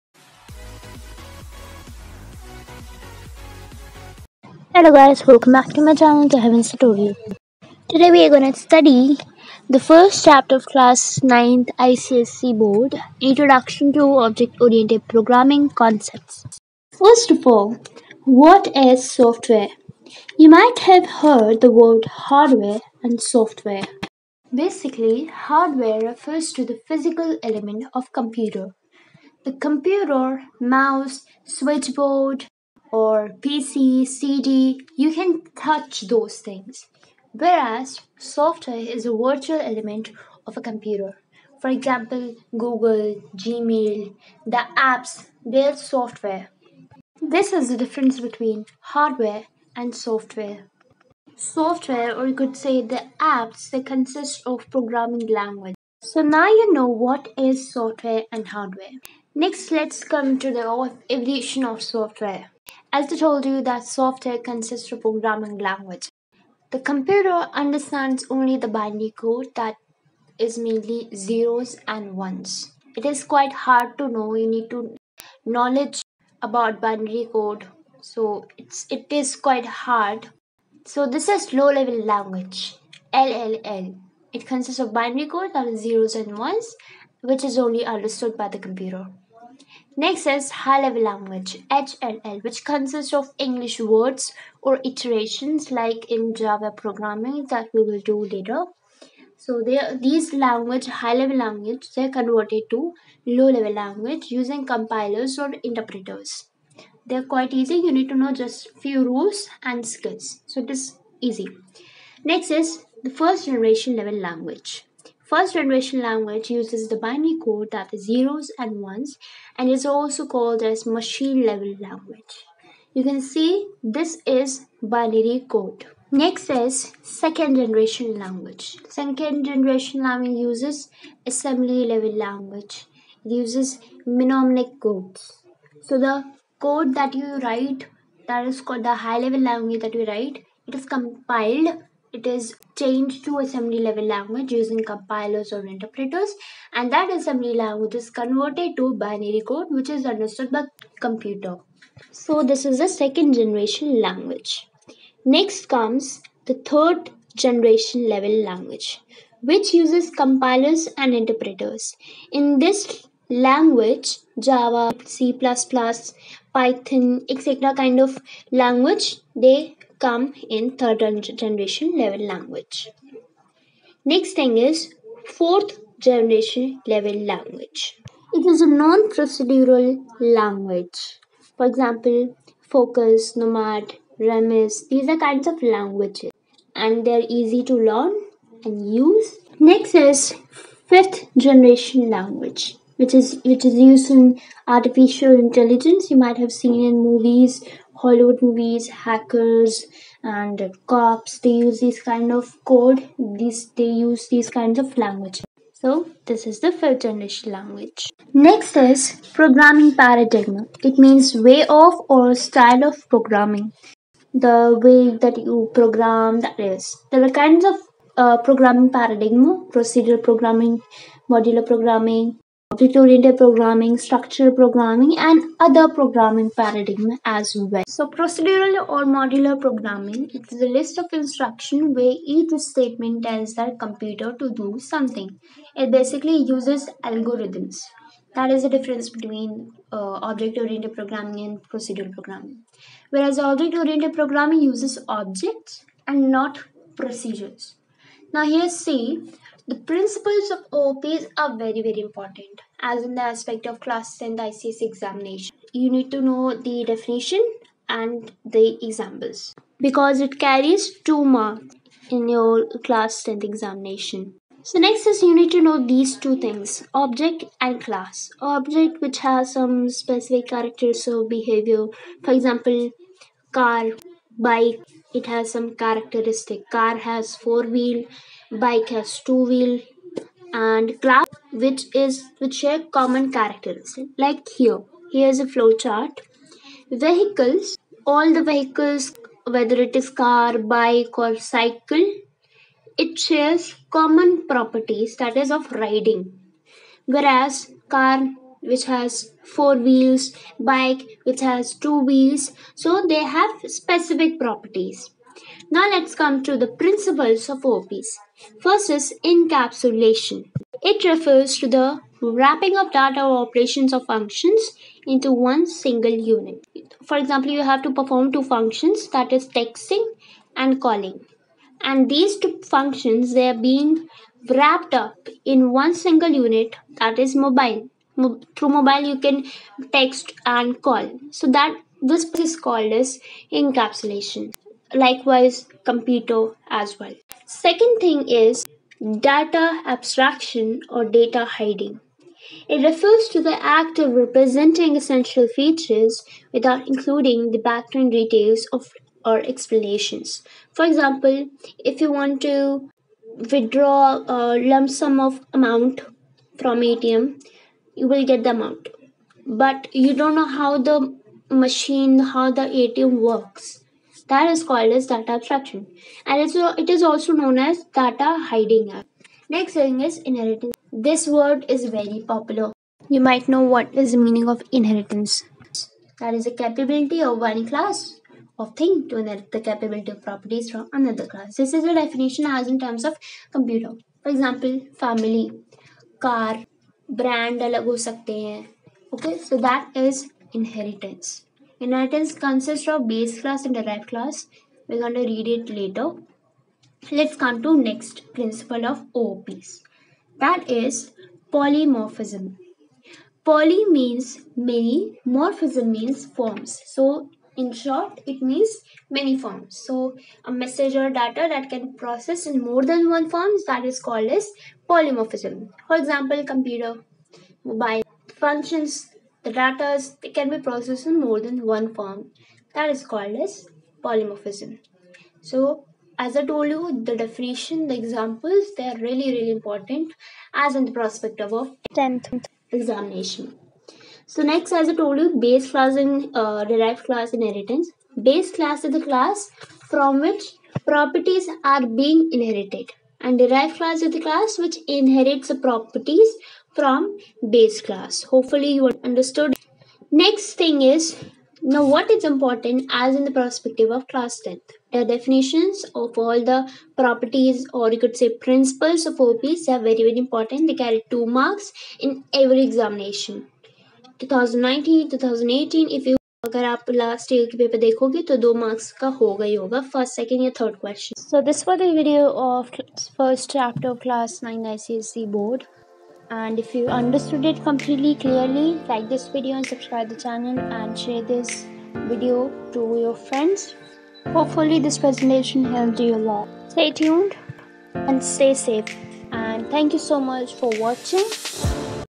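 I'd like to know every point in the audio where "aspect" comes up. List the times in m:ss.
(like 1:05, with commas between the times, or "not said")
4:13.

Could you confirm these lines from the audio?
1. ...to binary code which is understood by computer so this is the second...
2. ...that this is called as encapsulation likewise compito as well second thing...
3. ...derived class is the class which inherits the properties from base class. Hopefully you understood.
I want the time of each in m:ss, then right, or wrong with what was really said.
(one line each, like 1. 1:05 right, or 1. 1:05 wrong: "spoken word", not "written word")
1. 2:28 right
2. 5:31 right
3. 7:23 right.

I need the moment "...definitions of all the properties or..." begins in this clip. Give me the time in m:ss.
7:35.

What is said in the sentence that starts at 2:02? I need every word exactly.
You can see this is binary code.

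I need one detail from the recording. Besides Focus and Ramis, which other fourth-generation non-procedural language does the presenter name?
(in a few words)
Nomad.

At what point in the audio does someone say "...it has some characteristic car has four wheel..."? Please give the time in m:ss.
4:35.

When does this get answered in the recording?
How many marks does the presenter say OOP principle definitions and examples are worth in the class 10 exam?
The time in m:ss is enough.
4:20.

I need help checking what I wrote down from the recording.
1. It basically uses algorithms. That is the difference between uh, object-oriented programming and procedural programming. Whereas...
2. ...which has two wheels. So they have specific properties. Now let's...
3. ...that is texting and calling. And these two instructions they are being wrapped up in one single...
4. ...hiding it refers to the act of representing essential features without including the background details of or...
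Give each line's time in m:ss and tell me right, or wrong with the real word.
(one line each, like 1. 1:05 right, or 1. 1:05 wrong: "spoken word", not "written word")
1. 3:55 right
2. 5:01 right
3. 5:19 wrong: "functions", not "instructions"
4. 5:41 right.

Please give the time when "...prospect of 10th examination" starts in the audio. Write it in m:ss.
7:10.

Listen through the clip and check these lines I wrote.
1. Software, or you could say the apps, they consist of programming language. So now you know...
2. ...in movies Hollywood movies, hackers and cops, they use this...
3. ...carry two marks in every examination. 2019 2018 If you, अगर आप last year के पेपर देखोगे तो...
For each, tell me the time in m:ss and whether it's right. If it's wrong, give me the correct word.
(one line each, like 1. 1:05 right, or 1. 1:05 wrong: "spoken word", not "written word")
1. 0:51 right
2. 3:16 right
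3. 7:40 right.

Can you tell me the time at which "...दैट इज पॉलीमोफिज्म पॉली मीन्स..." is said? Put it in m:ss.
6:40.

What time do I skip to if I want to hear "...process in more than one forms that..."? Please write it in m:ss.
6:52.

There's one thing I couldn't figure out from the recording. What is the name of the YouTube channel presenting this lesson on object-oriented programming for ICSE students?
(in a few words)
The Heavens Tutorial.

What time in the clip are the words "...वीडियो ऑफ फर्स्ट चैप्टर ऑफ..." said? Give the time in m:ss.
7:51.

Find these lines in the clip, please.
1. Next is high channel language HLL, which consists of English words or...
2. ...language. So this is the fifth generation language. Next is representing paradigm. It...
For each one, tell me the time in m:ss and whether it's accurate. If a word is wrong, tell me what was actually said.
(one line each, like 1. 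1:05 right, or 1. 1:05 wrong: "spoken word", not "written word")
1. 1:30 wrong: "level", not "channel"
2. 3:24 wrong: "programming", not "representing".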